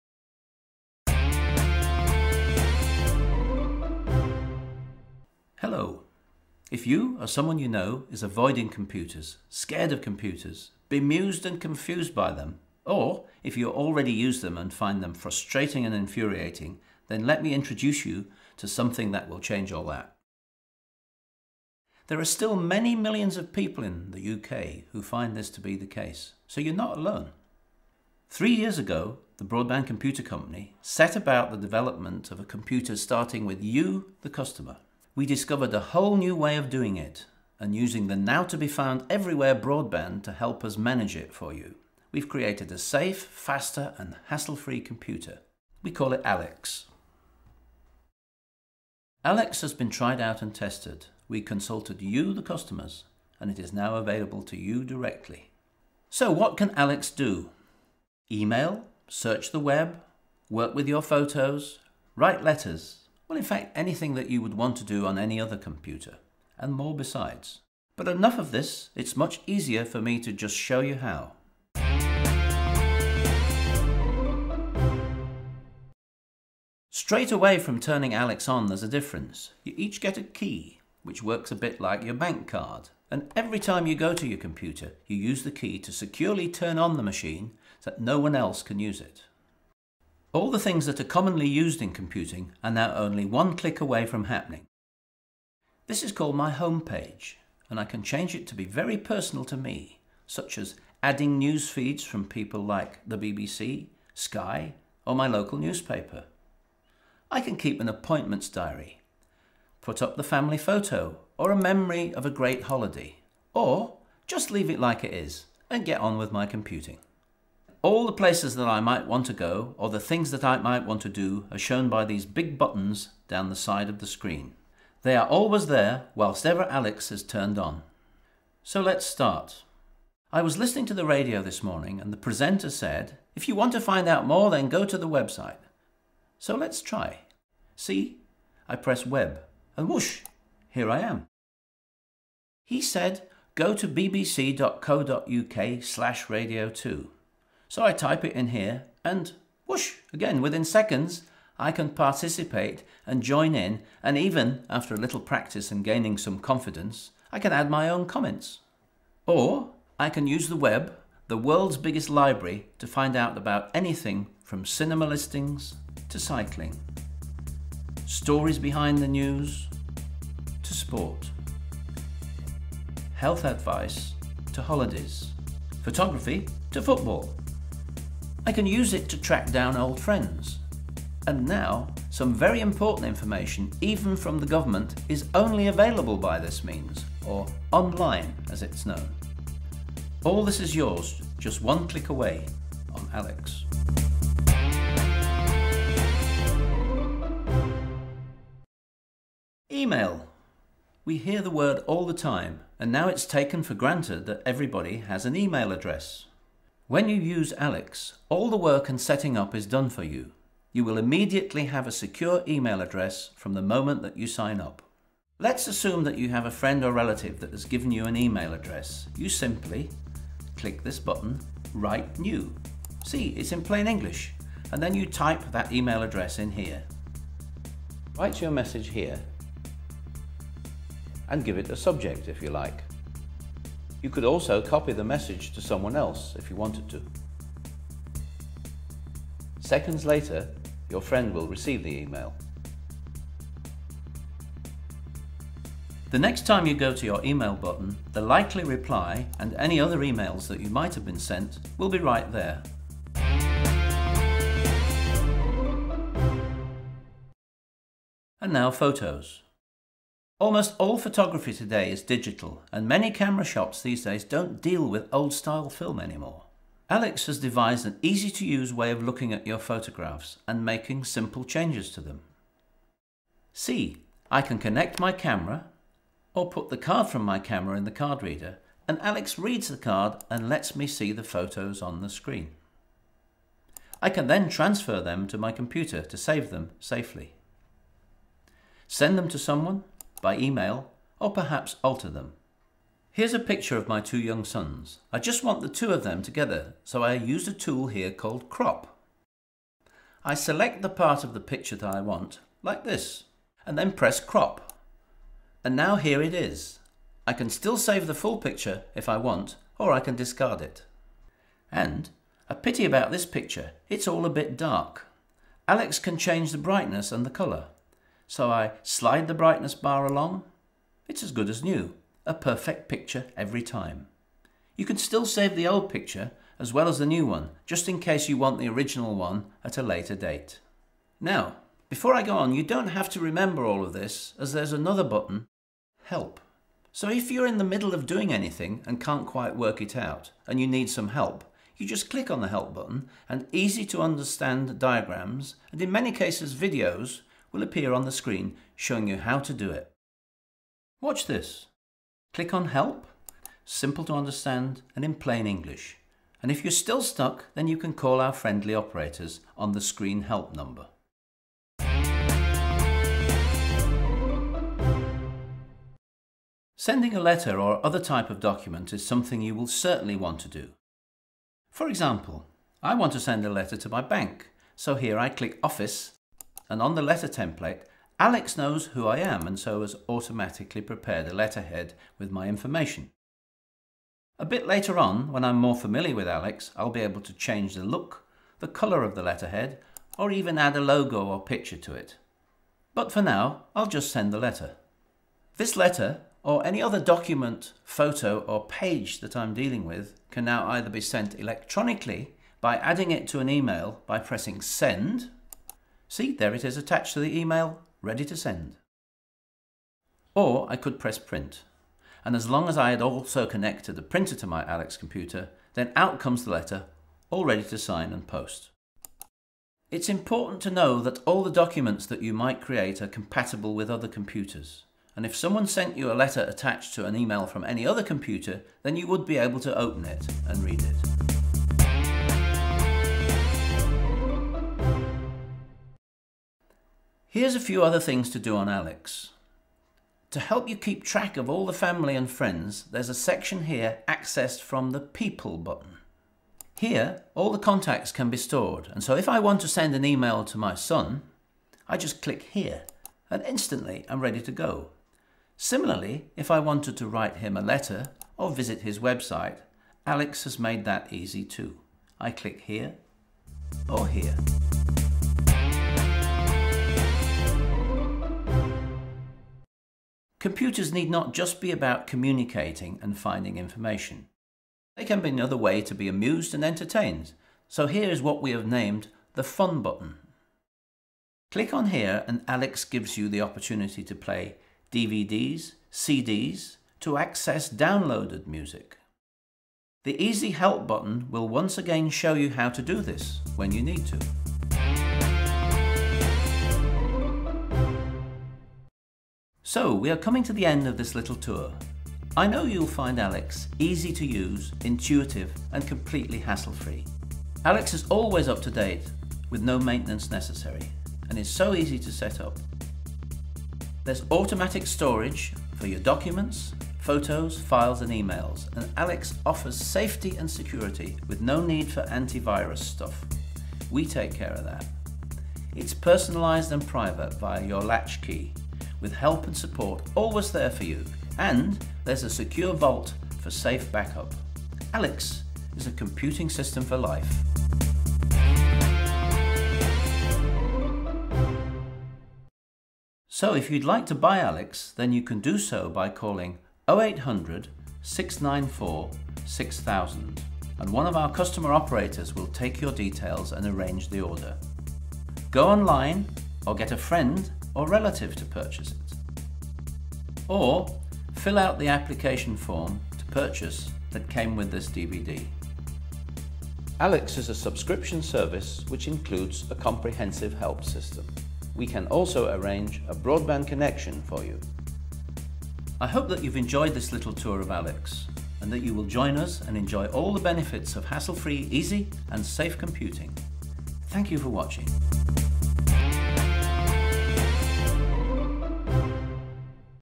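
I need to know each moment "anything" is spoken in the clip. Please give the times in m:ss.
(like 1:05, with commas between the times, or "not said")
1:03, 2:43, 5:38.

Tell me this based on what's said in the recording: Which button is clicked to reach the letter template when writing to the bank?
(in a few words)
Office.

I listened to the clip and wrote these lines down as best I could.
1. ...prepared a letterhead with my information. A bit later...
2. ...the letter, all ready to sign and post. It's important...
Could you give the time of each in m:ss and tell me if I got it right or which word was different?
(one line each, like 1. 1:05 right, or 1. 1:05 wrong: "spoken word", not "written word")
1. 6:20 right
2. 6:56 right.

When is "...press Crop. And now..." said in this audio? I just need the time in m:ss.
5:03.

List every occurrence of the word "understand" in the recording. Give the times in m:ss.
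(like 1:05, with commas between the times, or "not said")
5:44, 5:54.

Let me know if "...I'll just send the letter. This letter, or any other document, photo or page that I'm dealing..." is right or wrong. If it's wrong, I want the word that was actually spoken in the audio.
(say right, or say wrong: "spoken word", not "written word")
right.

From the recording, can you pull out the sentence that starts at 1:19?
You each get a key, which works a bit like your bank card.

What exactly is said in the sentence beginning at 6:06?
Sending a letter or other type of document is something you will certainly want to do.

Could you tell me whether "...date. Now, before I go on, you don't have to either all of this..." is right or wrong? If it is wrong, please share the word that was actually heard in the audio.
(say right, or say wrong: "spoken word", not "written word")
wrong: "remember", not "either".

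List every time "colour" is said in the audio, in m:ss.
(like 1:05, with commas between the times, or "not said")
5:17, 6:28.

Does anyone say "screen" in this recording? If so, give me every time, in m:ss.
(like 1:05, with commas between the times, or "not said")
2:04, 4:42, 5:48, 5:59.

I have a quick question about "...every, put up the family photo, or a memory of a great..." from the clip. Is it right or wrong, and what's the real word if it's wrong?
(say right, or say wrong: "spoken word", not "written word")
wrong: "diary", not "every".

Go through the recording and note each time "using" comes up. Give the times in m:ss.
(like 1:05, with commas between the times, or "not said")
0:37.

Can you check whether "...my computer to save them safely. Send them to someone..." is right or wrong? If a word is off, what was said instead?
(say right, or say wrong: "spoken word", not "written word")
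right.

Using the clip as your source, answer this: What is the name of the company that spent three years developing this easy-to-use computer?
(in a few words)
Broadband Computer Company.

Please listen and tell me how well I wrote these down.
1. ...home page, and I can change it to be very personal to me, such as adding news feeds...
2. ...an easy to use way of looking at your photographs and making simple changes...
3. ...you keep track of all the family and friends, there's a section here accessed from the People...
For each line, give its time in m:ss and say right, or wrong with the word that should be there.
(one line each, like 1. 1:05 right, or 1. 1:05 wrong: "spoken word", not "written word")
1. 1:36 right
2. 4:27 right
3. 7:20 right.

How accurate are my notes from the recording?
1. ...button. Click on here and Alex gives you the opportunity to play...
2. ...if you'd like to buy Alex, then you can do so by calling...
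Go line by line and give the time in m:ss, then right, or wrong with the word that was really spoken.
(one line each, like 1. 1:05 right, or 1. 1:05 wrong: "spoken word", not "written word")
1. 7:59 right
2. 9:03 right.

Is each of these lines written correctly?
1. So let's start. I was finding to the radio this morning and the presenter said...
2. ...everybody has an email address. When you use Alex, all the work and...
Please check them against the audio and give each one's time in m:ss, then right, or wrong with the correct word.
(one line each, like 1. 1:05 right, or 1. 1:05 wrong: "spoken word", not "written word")
1. 2:08 wrong: "listening", not "finding"
2. 3:24 right.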